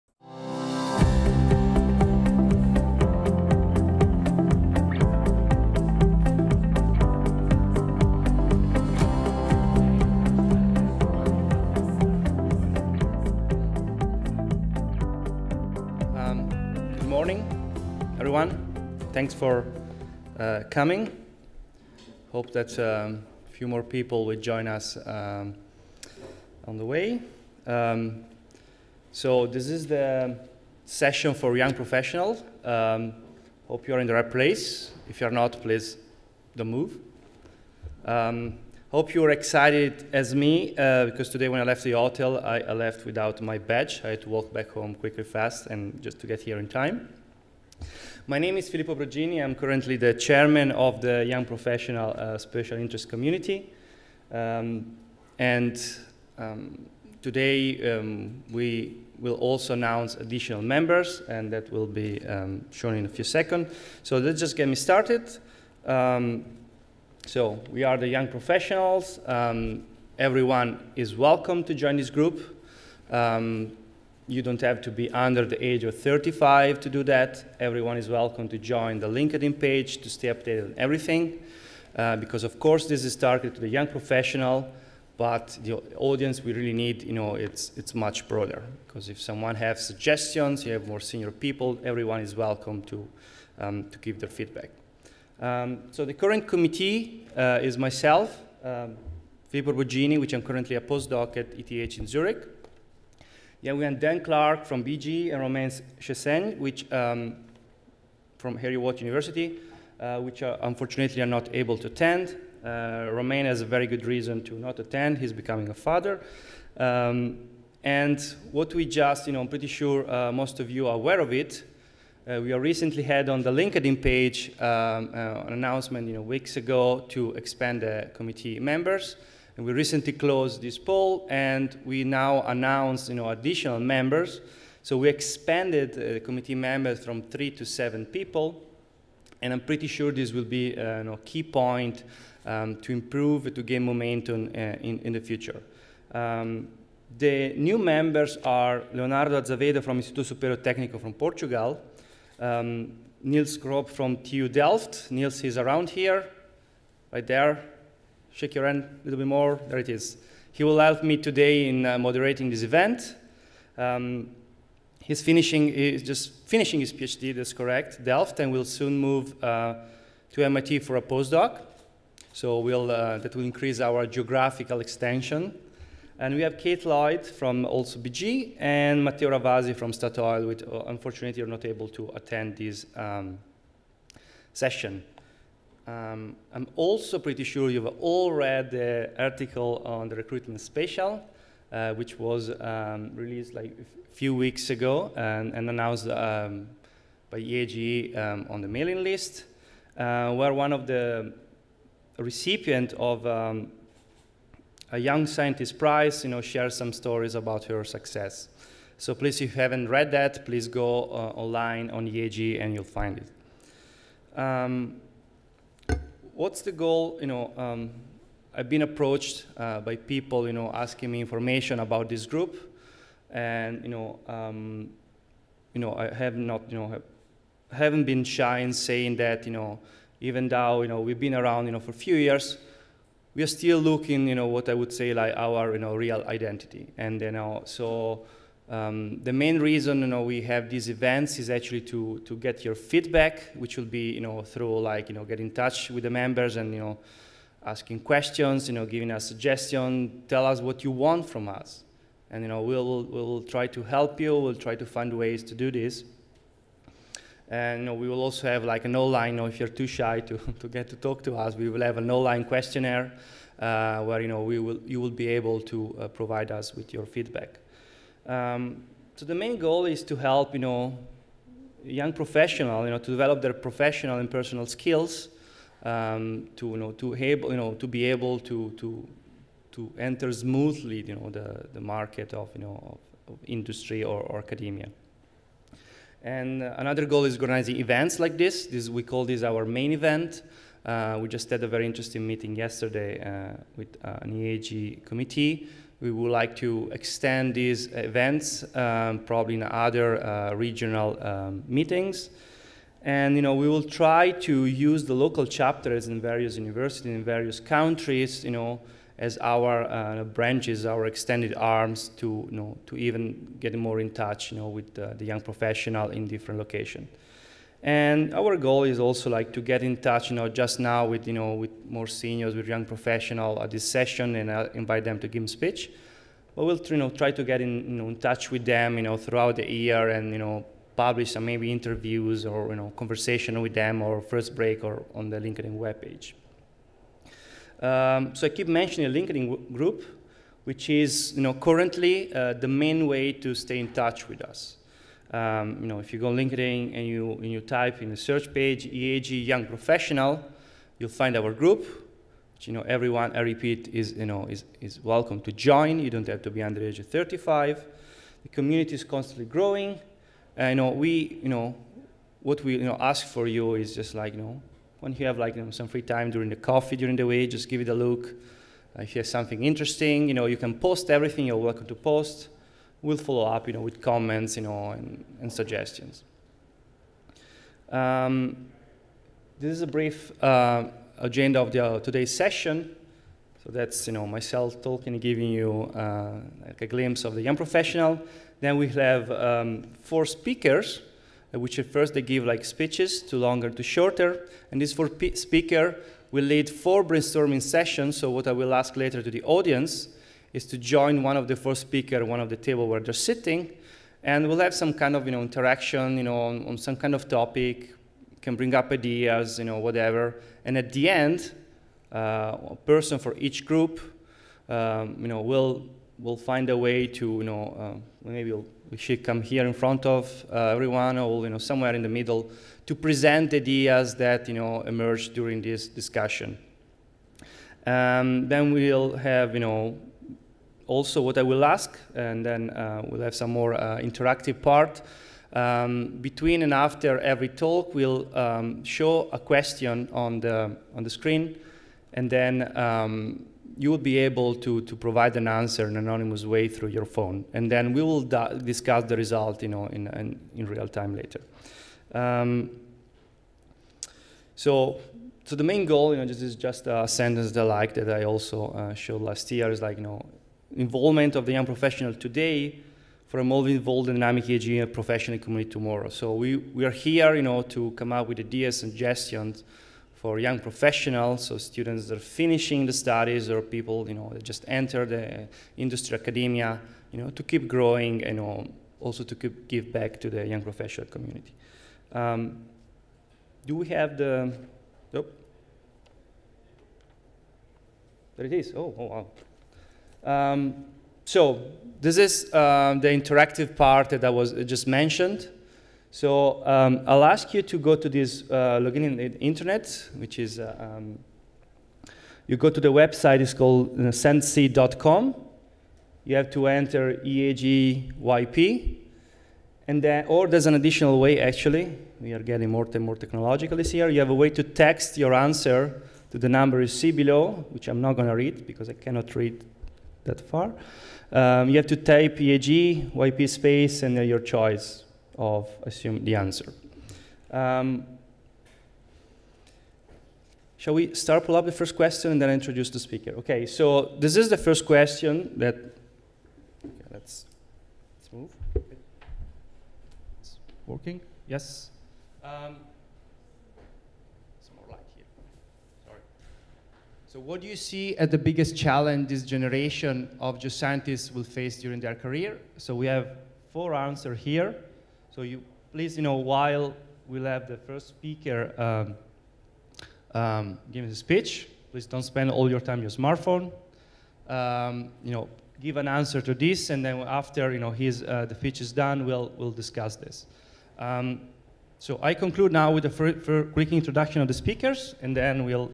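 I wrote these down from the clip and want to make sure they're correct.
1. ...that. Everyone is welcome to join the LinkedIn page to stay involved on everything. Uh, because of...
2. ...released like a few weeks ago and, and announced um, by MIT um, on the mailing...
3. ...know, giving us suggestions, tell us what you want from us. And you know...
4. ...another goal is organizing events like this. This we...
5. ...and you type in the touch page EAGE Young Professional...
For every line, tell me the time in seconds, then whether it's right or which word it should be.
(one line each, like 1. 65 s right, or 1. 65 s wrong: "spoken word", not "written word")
1. 77 s wrong: "updated", not "involved"
2. 193 s wrong: "EAGE", not "MIT"
3. 248 s right
4. 286 s right
5. 347 s wrong: "search", not "touch".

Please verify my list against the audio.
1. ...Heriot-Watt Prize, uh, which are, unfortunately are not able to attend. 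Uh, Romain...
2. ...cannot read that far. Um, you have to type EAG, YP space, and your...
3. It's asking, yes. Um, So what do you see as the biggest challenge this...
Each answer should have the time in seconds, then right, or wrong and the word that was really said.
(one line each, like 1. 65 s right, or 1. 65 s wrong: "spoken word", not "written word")
1. 108 s wrong: "University", not "Prize"
2. 518 s right
3. 540 s wrong: "working", not "asking".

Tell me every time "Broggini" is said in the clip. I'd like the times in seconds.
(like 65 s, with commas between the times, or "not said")
48 s, 99 s.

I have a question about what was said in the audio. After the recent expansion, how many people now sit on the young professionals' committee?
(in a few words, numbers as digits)
7.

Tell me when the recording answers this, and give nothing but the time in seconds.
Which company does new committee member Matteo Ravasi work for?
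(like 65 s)
179 s.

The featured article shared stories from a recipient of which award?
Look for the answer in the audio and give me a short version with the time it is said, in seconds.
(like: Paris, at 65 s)
Young Scientist Prize, at 204 s.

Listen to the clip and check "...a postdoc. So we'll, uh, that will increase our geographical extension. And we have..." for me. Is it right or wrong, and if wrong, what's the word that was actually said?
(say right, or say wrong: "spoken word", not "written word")
right.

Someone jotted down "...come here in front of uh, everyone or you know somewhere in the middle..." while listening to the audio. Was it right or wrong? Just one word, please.
right.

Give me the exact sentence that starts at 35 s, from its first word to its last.
If you're not, please don't move.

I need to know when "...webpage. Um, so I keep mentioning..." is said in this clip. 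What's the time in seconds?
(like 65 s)
335 s.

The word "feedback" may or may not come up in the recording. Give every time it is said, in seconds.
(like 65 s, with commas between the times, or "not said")
94 s, 242 s, 267 s.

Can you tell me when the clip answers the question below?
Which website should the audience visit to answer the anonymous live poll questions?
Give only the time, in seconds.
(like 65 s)
504 s.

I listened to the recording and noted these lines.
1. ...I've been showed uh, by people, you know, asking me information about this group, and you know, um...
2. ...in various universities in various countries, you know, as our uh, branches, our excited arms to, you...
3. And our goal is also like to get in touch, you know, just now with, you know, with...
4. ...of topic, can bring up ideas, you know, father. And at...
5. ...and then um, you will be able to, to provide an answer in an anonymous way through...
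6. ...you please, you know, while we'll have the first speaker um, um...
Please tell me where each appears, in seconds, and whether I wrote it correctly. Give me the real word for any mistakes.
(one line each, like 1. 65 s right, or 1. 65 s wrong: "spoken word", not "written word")
1. 218 s wrong: "approached", not "showed"
2. 306 s wrong: "extended", not "excited"
3. 317 s right
4. 407 s wrong: "whatever", not "father"
5. 442 s right
6. 555 s right.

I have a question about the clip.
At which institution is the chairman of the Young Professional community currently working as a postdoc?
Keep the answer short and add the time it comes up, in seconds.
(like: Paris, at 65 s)
ETH in Zurich, at 101 s.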